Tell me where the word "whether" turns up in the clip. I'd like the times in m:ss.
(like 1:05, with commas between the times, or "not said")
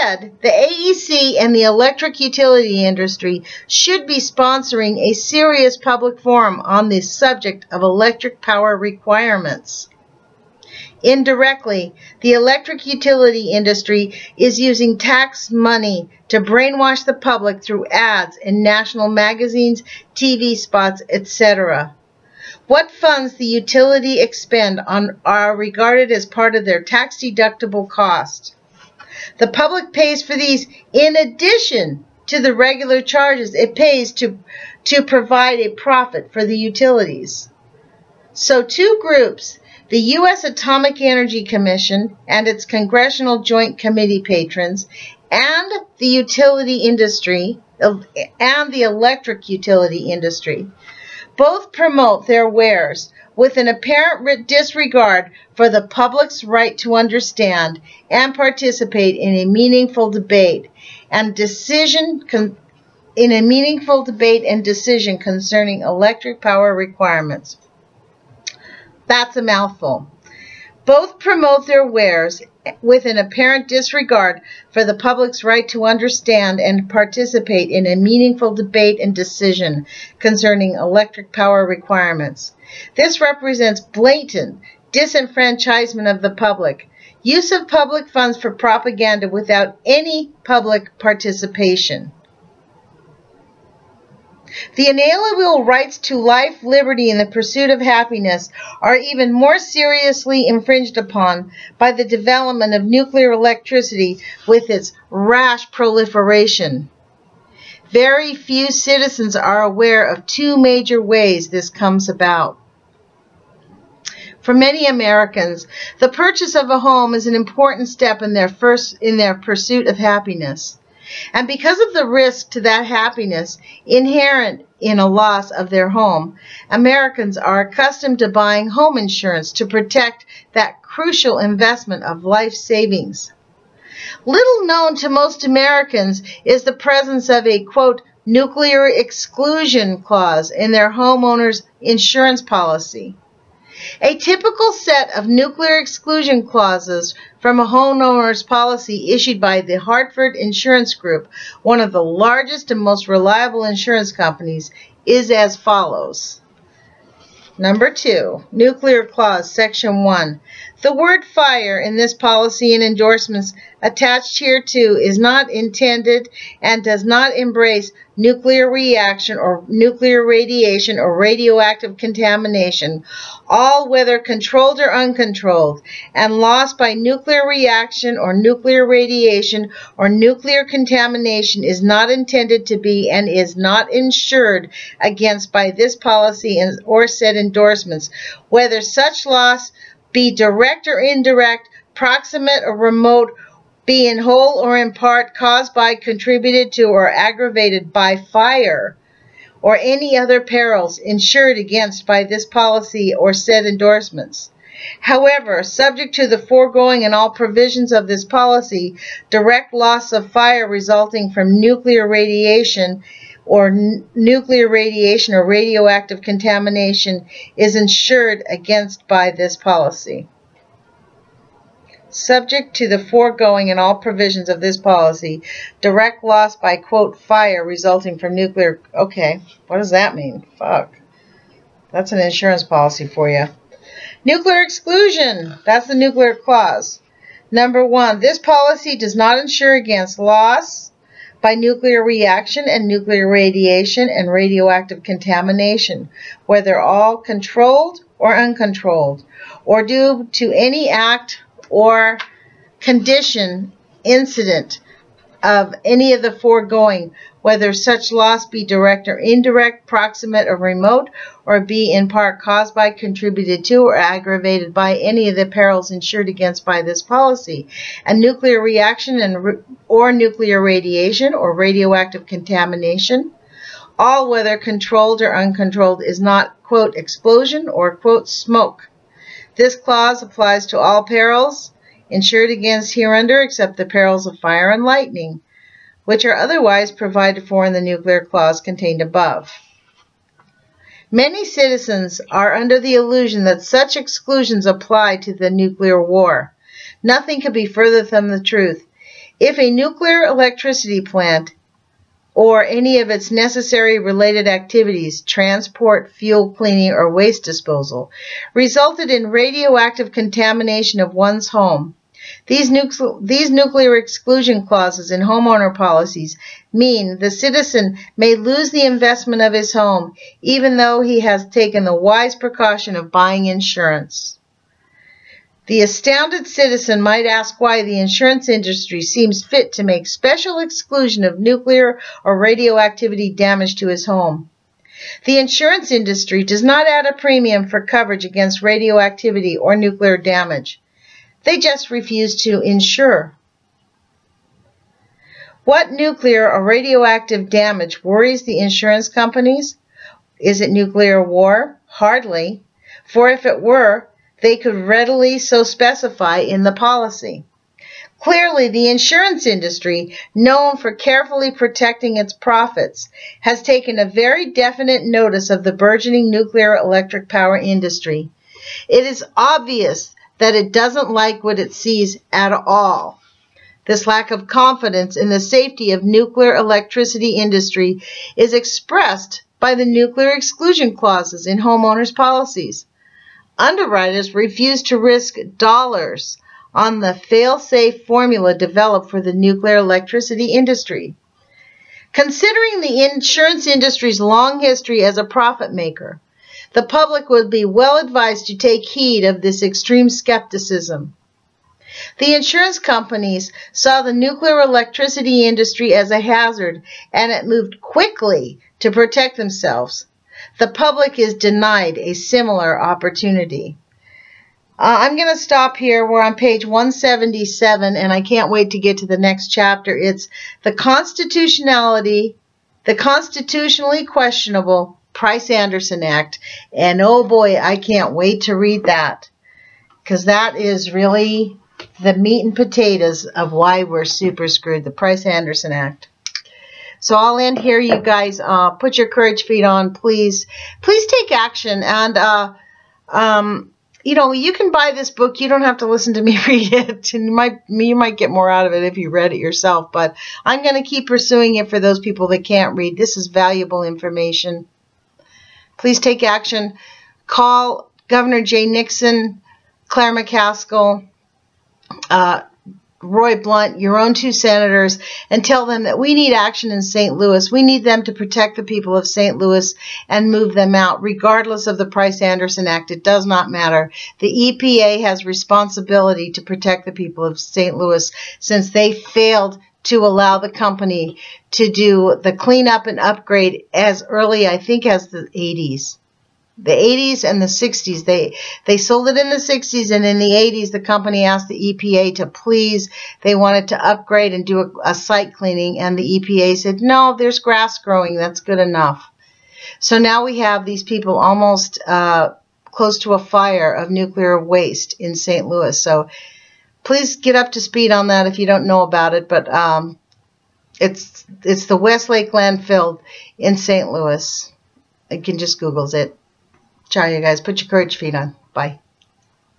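2:53, 3:08, 4:06, 4:17, 4:34.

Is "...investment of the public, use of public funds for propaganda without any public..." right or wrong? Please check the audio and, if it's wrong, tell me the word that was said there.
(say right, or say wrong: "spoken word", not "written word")
wrong: "disenfranchisement", not "investment".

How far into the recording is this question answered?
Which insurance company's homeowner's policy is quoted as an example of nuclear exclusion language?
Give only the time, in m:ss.
2:29.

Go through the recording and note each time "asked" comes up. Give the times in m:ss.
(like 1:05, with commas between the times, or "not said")
8:11.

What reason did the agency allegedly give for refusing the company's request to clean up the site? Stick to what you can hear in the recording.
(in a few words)
Grass growing.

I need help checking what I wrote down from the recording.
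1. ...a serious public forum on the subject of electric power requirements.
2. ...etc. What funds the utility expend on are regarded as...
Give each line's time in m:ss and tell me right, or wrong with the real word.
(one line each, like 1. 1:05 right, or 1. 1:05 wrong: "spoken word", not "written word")
1. 0:04 right
2. 0:21 right.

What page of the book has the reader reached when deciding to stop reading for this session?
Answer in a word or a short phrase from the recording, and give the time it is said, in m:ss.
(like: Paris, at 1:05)
177, at 6:56.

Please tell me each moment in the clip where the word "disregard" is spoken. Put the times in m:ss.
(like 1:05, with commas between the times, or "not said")
0:54, 1:13.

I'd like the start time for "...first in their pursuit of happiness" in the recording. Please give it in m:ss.
1:58.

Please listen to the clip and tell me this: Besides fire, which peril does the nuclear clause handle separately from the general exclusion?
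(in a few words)
Lightning.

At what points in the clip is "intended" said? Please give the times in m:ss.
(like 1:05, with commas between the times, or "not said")
2:45, 3:02.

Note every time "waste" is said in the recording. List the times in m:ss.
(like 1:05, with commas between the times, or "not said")
5:07, 8:24.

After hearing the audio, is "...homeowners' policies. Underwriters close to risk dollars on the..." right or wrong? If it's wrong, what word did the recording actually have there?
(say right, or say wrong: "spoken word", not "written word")
wrong: "refuse", not "close".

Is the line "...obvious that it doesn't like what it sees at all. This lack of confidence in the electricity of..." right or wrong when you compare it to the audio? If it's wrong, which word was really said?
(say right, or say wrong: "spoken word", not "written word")
wrong: "safety", not "electricity".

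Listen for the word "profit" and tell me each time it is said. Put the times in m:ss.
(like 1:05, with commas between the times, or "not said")
0:35, 6:02, 6:35.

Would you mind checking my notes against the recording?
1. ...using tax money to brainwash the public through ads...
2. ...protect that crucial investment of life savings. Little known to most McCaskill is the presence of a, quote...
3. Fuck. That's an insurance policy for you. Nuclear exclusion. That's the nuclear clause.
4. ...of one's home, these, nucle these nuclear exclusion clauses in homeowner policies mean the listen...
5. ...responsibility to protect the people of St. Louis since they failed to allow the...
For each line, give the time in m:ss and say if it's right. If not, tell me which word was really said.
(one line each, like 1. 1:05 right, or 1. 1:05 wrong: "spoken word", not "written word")
1. 0:14 right
2. 2:09 wrong: "Americans", not "McCaskill"
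3. 3:50 right
4. 5:10 wrong: "citizen", not "listen"
5. 7:55 right.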